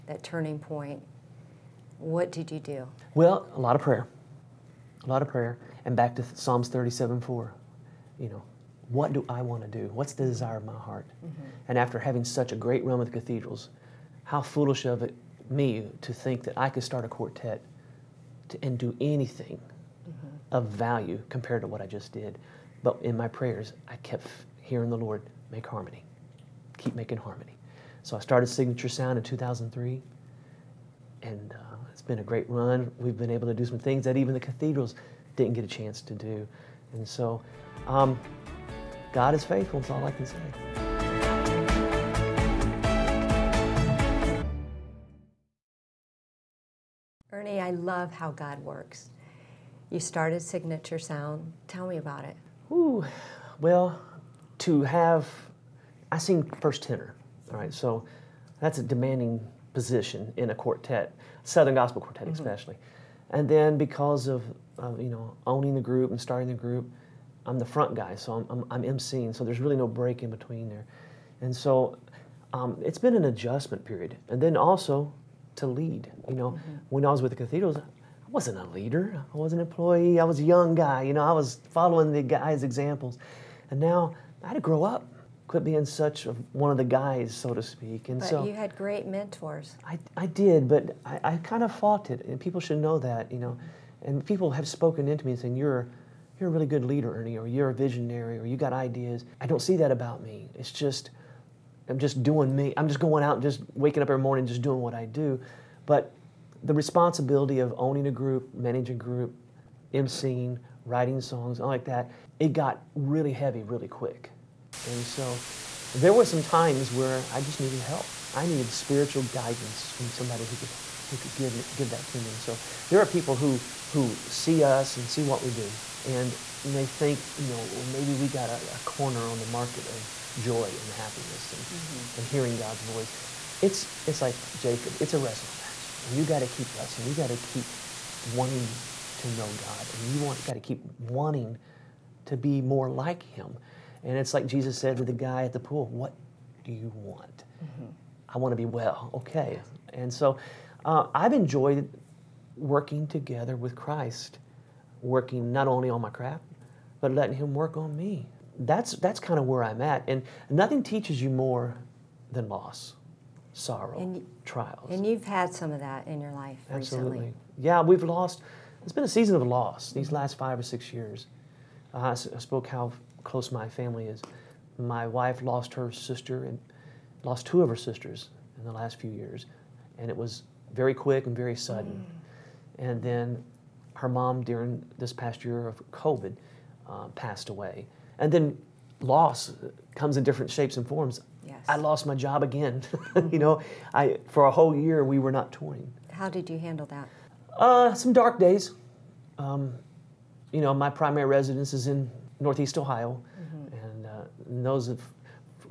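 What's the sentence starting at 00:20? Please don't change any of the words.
of value compared to what I just did.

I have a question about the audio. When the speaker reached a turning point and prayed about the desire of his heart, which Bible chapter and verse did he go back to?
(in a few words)
Psalms 37:4.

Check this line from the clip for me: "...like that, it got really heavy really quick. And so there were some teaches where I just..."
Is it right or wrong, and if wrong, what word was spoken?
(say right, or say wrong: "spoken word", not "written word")
wrong: "times", not "teaches".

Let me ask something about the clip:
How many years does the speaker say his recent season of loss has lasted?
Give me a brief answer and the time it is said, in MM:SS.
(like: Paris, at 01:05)
5 or 6 years, at 02:50.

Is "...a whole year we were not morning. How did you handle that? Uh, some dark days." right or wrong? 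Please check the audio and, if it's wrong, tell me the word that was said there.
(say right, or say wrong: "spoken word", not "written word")
wrong: "touring", not "morning".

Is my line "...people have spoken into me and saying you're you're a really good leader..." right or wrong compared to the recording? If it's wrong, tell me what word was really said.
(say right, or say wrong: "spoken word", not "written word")
right.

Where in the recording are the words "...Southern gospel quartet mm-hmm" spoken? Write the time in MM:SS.
01:01.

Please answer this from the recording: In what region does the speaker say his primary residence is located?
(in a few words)
Northeast Ohio.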